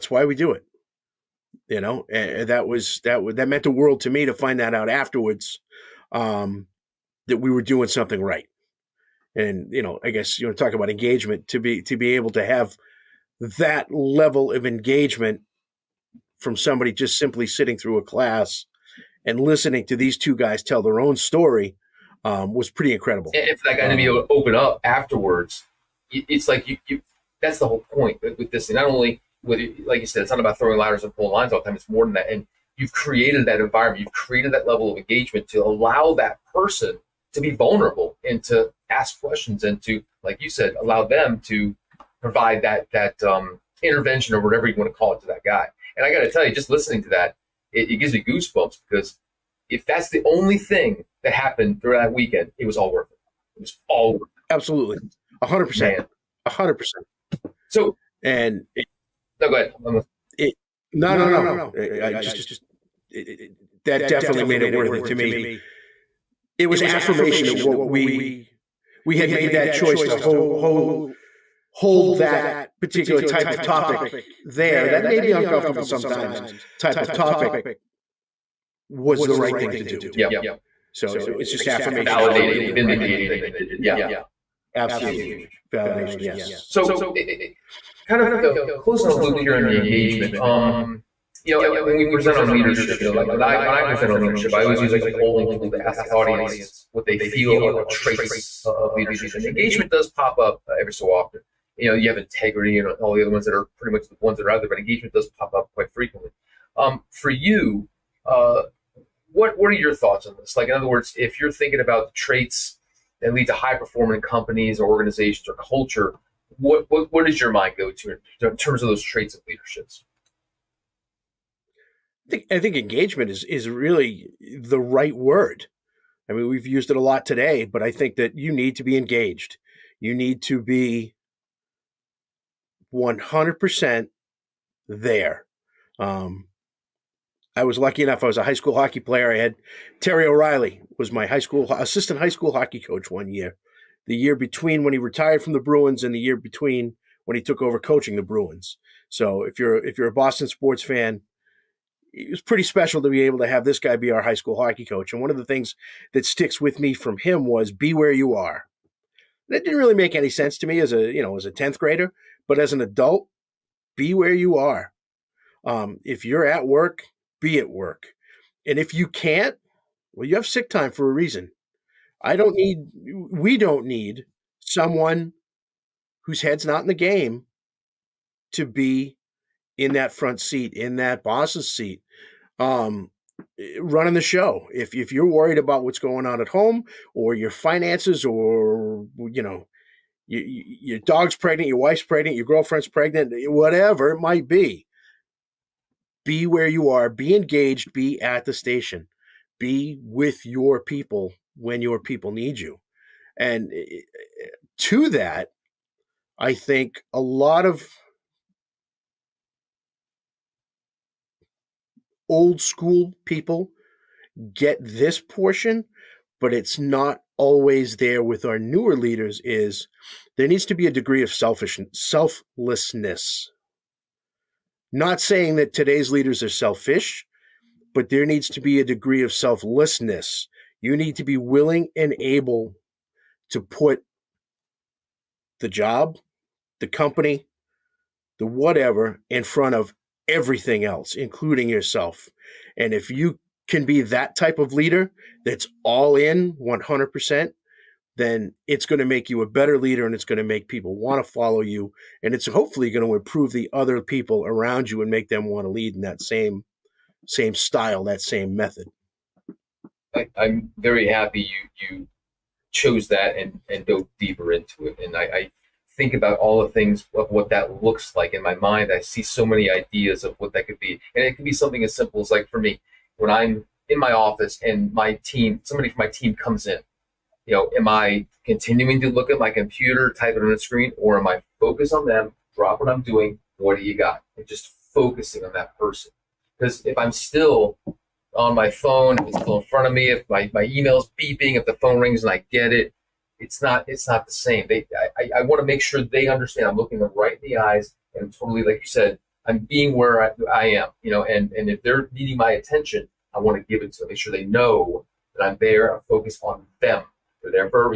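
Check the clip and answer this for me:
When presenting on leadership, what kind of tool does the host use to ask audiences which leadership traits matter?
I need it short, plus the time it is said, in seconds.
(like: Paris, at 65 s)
polling tool, at 95 s.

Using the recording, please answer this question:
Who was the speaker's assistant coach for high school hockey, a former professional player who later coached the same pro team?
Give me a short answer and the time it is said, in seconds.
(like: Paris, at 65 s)
Terry O'Reilly, at 140 s.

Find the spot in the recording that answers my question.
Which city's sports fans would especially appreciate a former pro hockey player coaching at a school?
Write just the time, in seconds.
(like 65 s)
150 s.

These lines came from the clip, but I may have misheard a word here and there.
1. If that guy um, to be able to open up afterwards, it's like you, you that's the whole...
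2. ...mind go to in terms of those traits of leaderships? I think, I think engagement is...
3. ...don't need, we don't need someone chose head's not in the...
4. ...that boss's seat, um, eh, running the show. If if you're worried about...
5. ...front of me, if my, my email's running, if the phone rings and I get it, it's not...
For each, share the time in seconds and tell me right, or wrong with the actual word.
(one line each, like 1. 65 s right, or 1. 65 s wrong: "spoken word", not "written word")
1. 23 s right
2. 117 s right
3. 172 s wrong: "whose", not "chose"
4. 180 s right
5. 289 s wrong: "beeping", not "running".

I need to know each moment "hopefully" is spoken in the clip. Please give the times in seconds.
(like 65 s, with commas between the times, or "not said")
252 s.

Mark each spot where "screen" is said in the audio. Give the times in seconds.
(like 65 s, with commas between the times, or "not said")
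280 s.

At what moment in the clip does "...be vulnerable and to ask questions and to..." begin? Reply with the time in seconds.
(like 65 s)
37 s.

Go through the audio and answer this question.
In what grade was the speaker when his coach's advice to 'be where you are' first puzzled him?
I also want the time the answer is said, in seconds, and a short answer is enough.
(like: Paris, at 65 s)
10th grade, at 161 s.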